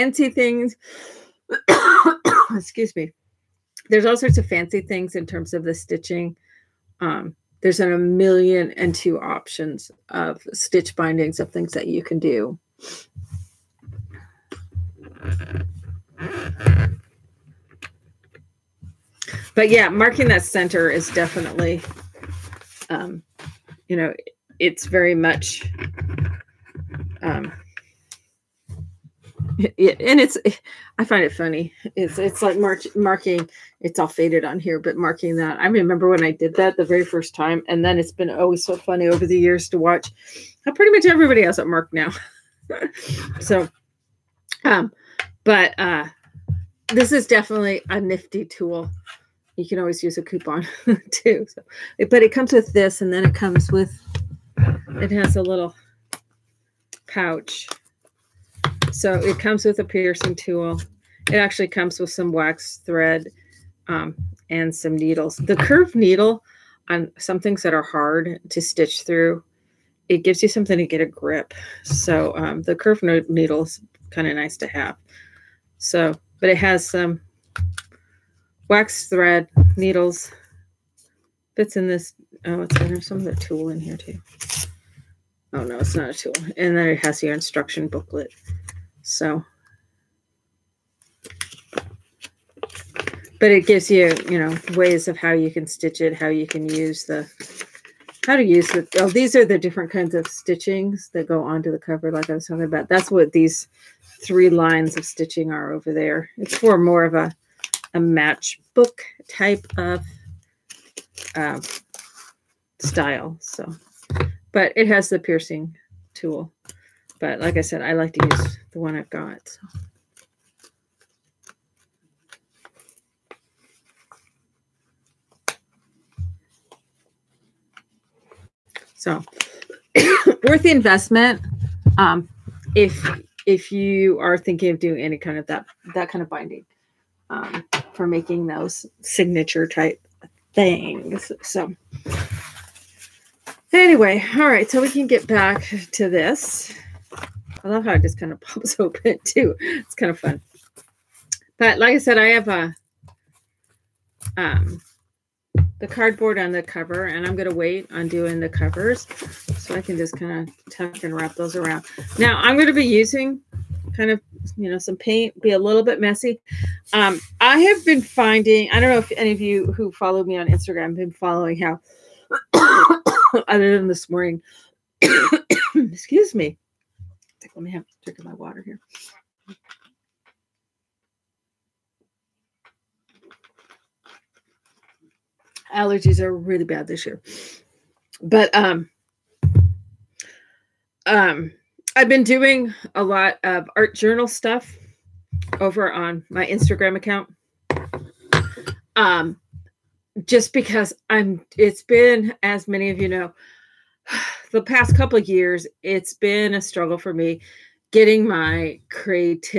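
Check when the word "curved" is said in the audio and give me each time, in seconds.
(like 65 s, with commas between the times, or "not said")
65 s, 72 s.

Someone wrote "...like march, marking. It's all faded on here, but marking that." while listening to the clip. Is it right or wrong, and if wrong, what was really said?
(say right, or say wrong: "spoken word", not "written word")
right.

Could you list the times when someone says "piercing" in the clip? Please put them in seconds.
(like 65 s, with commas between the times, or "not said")
59 s, 115 s.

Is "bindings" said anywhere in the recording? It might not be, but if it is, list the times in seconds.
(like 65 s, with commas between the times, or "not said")
10 s, 136 s.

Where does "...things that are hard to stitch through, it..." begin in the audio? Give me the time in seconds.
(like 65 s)
67 s.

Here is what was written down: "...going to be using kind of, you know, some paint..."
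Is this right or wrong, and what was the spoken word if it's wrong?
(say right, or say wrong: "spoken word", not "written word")
right.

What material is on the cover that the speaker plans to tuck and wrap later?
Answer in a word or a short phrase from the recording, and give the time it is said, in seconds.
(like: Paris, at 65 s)
Cardboard, at 155 s.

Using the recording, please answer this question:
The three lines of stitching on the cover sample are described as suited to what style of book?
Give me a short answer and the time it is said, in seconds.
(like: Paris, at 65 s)
Matchbook, at 107 s.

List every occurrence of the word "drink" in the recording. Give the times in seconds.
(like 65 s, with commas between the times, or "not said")
178 s.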